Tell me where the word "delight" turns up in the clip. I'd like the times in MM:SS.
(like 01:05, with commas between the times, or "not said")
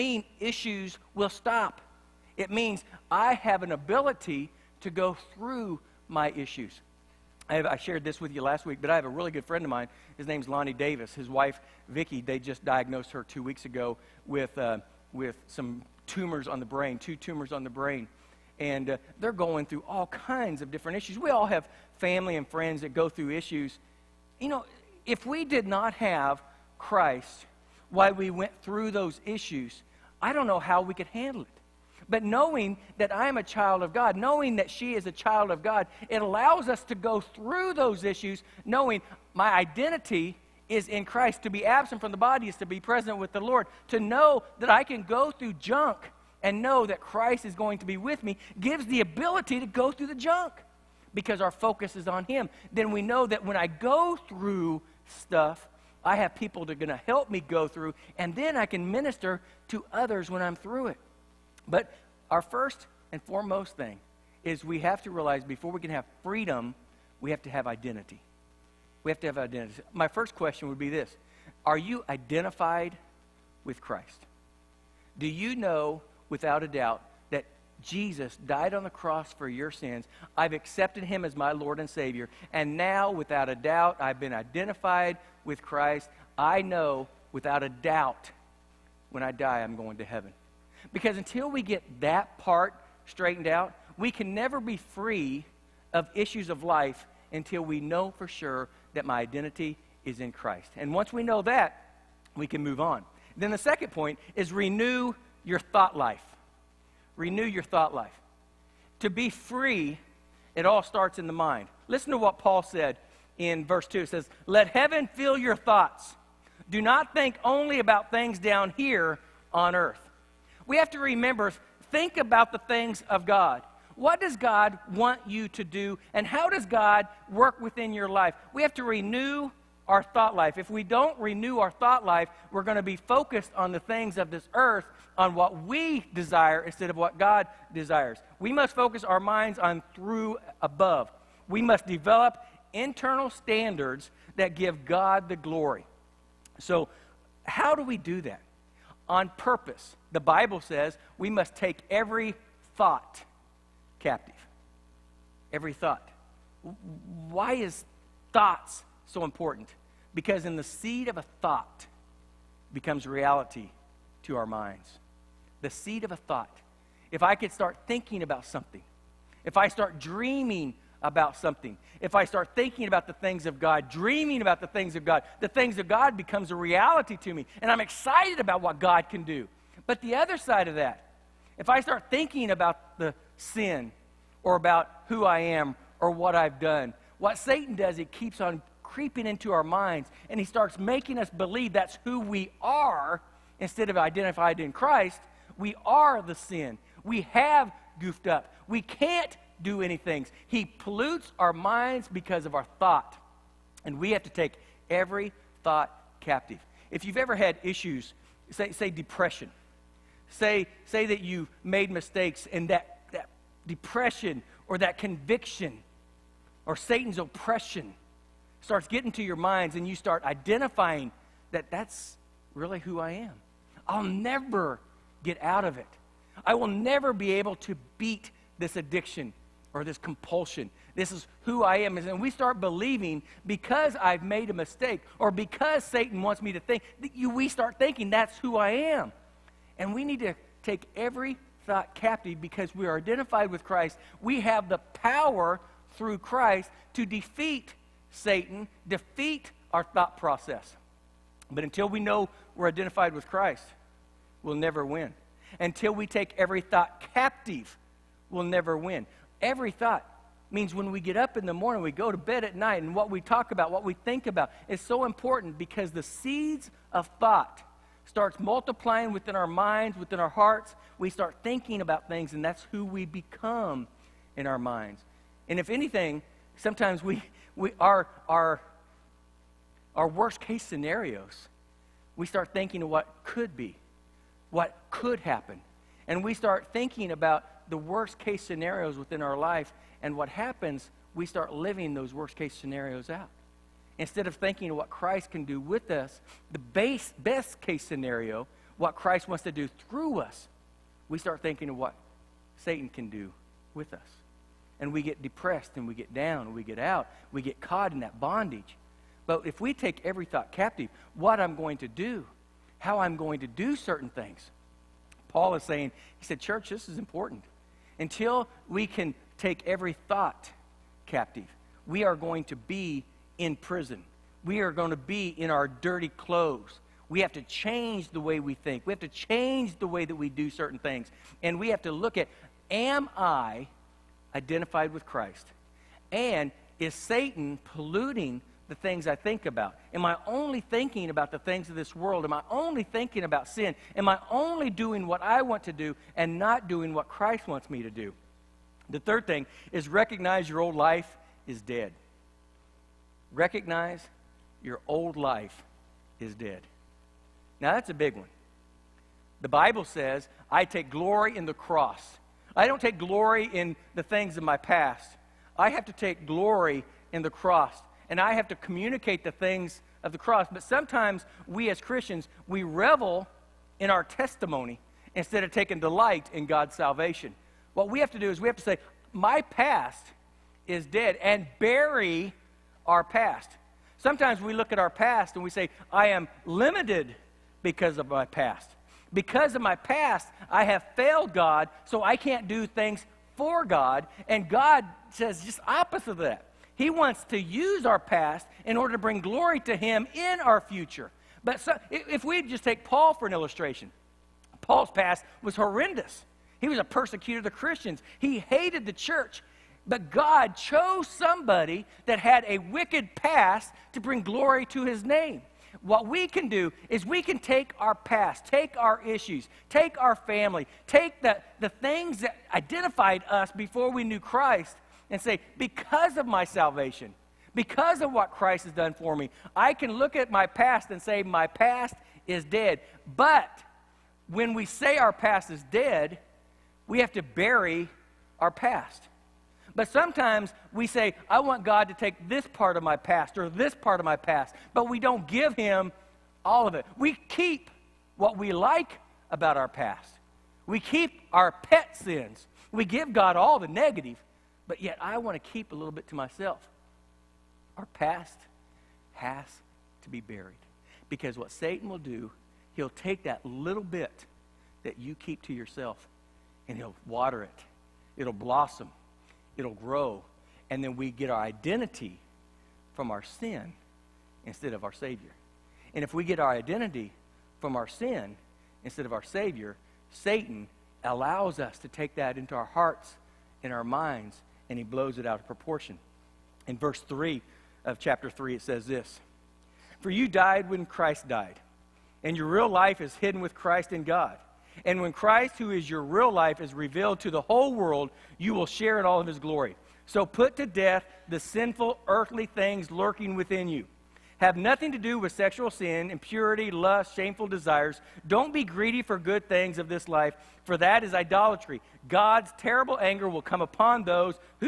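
06:15.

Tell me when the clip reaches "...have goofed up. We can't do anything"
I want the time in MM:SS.
03:17.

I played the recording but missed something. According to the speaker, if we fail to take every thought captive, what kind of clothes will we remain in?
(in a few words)
dirty clothes.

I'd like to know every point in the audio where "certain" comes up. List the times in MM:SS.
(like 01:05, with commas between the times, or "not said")
05:13, 05:30.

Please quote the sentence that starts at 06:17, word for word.
What we have to do is we have to say, My past is dead, and bury our past.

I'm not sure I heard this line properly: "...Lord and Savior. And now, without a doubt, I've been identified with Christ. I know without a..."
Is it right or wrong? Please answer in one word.
right.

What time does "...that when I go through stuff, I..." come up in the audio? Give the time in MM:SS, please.
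00:53.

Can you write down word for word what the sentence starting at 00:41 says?
To be absent from the body is to be present with the Lord.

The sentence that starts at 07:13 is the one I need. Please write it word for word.
But when we say our past is dead, we have to bury our past.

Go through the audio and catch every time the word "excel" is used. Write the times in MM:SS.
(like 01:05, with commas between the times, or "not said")
not said.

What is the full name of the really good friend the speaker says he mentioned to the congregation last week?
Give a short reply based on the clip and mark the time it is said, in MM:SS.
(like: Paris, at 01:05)
Lonnie Davis, at 00:10.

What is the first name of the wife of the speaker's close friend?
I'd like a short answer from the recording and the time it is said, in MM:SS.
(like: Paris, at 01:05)
Vicki, at 00:11.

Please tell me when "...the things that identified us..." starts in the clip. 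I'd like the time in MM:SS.
07:01.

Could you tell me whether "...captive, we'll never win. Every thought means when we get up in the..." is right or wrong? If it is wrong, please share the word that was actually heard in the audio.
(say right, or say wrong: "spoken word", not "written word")
right.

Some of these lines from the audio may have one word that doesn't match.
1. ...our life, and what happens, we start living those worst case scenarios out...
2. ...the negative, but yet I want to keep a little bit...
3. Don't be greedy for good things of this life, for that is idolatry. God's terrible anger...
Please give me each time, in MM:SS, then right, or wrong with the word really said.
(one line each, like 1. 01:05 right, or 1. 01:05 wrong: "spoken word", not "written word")
1. 04:49 right
2. 07:33 right
3. 08:28 right.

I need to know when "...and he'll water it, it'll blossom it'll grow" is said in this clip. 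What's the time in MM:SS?
07:46.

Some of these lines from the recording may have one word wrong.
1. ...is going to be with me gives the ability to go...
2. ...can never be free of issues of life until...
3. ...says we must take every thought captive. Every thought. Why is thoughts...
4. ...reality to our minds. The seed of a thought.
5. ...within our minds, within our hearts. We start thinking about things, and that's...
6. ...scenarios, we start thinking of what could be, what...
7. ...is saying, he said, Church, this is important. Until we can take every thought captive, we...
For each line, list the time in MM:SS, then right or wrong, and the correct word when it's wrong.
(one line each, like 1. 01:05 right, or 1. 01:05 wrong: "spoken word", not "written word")
1. 00:47 right
2. 01:34 right
3. 02:30 right
4. 02:43 right
5. 04:29 right
6. 04:40 right
7. 05:15 right.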